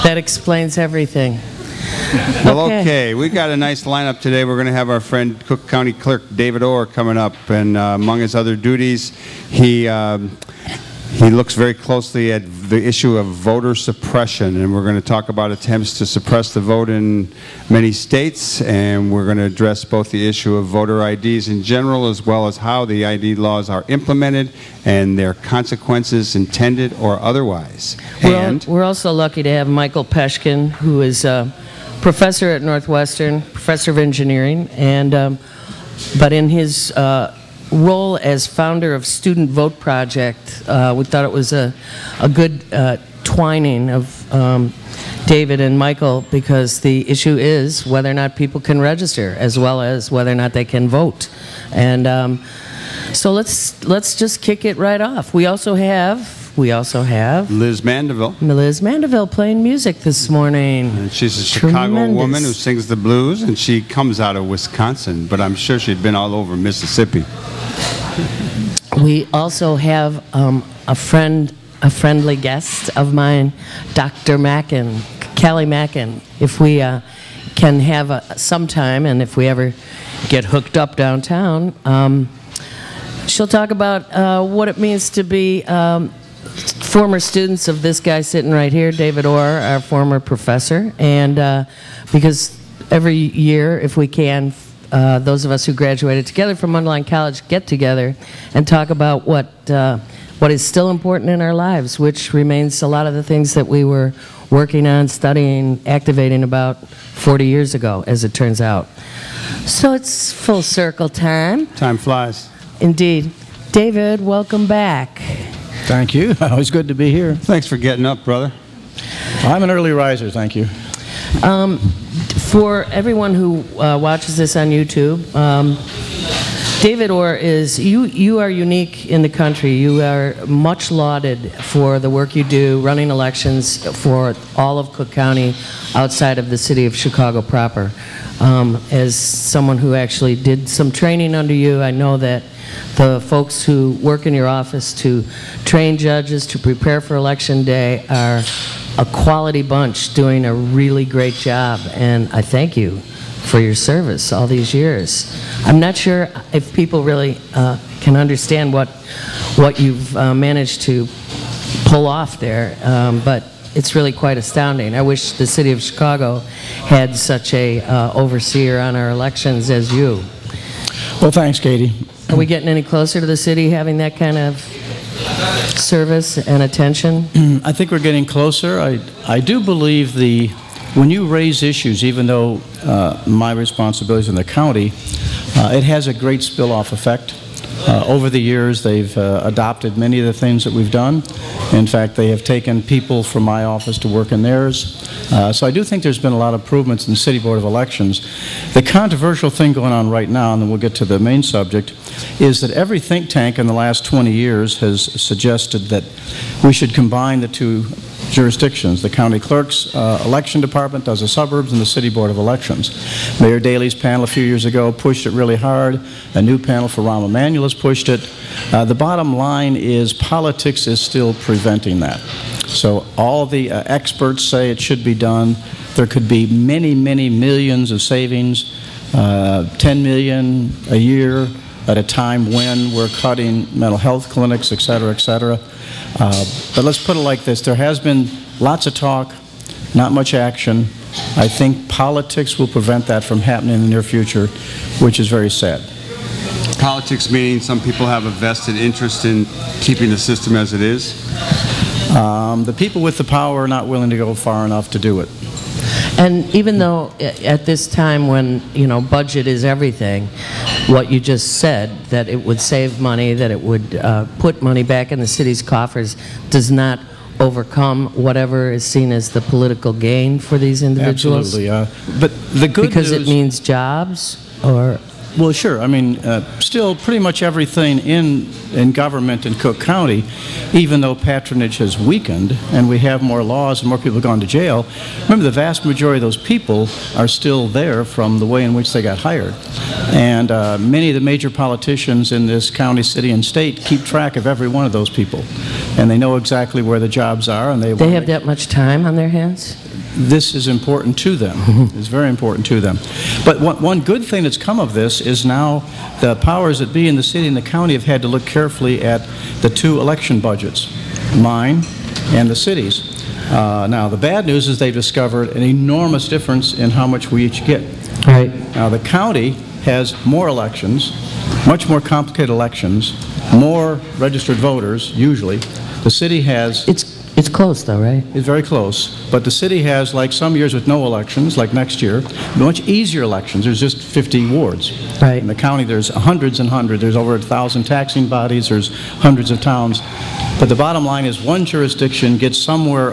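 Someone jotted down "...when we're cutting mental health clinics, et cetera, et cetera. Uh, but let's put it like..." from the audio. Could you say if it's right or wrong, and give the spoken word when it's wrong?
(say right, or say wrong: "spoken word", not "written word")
right.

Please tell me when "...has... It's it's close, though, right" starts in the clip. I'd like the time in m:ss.
5:26.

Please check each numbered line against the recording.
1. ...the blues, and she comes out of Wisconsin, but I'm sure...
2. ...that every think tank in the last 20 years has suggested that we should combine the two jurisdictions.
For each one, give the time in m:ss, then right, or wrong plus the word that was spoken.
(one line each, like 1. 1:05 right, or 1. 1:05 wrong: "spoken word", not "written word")
1. 1:02 right
2. 3:22 right.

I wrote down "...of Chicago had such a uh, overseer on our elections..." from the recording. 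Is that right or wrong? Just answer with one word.
right.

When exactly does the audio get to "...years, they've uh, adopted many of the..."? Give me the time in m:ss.
3:08.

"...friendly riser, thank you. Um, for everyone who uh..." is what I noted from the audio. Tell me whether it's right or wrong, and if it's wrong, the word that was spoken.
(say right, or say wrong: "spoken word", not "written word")
wrong: "early", not "friendly".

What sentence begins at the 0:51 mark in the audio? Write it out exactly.
And um, so let's let's just kick it right off.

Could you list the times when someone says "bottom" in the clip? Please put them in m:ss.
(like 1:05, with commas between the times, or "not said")
3:38, 5:40.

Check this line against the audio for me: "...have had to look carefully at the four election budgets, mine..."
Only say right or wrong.
wrong.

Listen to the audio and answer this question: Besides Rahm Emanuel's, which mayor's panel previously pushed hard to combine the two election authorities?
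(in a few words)
Mayor Daley.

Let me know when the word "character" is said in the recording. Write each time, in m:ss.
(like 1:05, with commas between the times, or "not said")
not said.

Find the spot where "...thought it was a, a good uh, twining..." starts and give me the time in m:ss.
0:41.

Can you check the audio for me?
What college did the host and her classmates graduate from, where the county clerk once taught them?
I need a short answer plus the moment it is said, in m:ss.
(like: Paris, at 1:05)
Mundelein College, at 1:36.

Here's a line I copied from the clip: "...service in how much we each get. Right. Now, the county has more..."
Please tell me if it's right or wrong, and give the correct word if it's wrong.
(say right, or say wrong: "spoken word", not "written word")
wrong: "difference", not "service".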